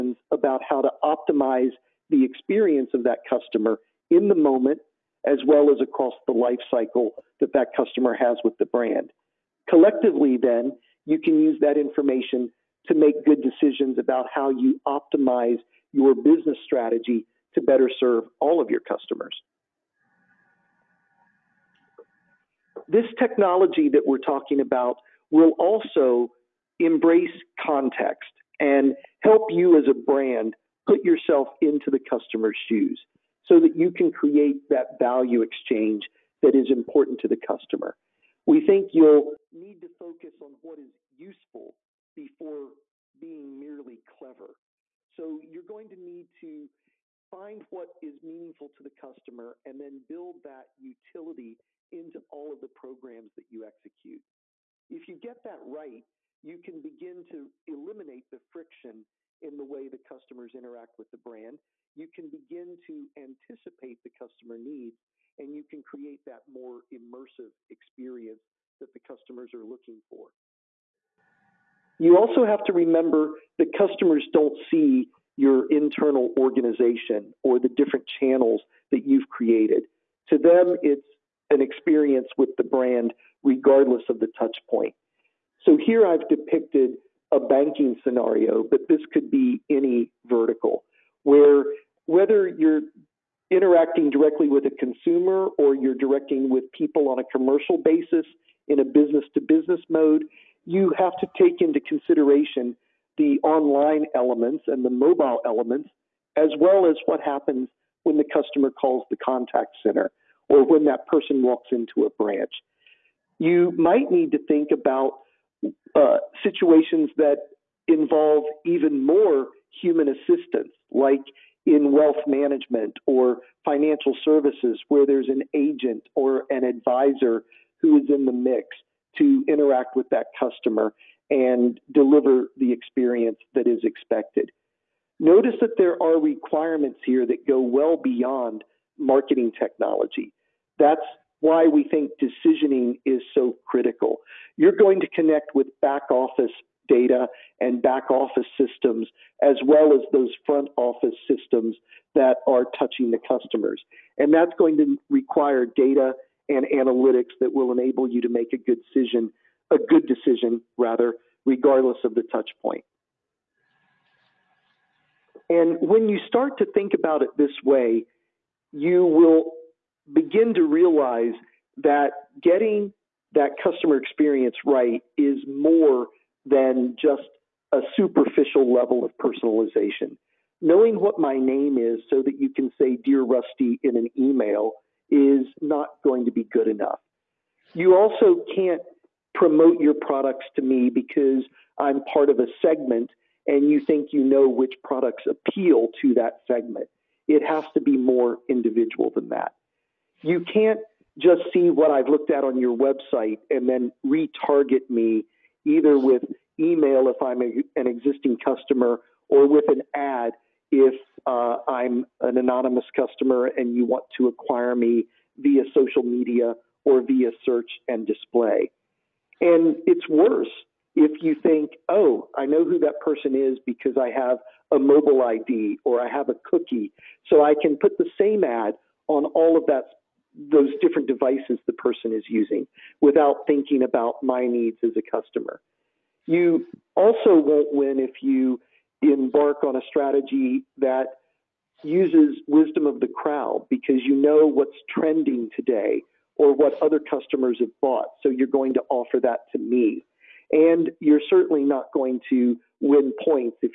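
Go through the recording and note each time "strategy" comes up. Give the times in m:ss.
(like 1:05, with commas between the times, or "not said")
0:16, 3:59.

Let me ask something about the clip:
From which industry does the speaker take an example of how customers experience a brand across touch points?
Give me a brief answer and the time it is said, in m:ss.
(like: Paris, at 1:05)
banking, at 1:27.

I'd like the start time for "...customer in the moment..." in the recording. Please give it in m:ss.
0:03.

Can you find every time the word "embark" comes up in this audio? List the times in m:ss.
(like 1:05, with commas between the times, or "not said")
3:59.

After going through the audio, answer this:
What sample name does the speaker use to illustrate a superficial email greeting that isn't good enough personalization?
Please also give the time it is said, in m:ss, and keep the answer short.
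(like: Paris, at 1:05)
Rusty, at 3:03.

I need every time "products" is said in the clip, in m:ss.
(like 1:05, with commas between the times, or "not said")
3:09, 3:14.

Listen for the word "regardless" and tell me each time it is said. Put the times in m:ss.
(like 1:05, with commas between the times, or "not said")
1:23, 2:41.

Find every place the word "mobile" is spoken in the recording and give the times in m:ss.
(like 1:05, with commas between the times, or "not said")
1:44, 3:44.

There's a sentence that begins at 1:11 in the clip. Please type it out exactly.
You also have to remember that customers don't see your internal organization or the different channels that you've created.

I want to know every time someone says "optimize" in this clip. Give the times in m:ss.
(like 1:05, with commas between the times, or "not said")
0:01, 0:14.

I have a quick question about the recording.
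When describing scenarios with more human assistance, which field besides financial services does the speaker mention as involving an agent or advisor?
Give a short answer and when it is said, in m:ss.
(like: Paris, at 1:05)
wealth management, at 2:01.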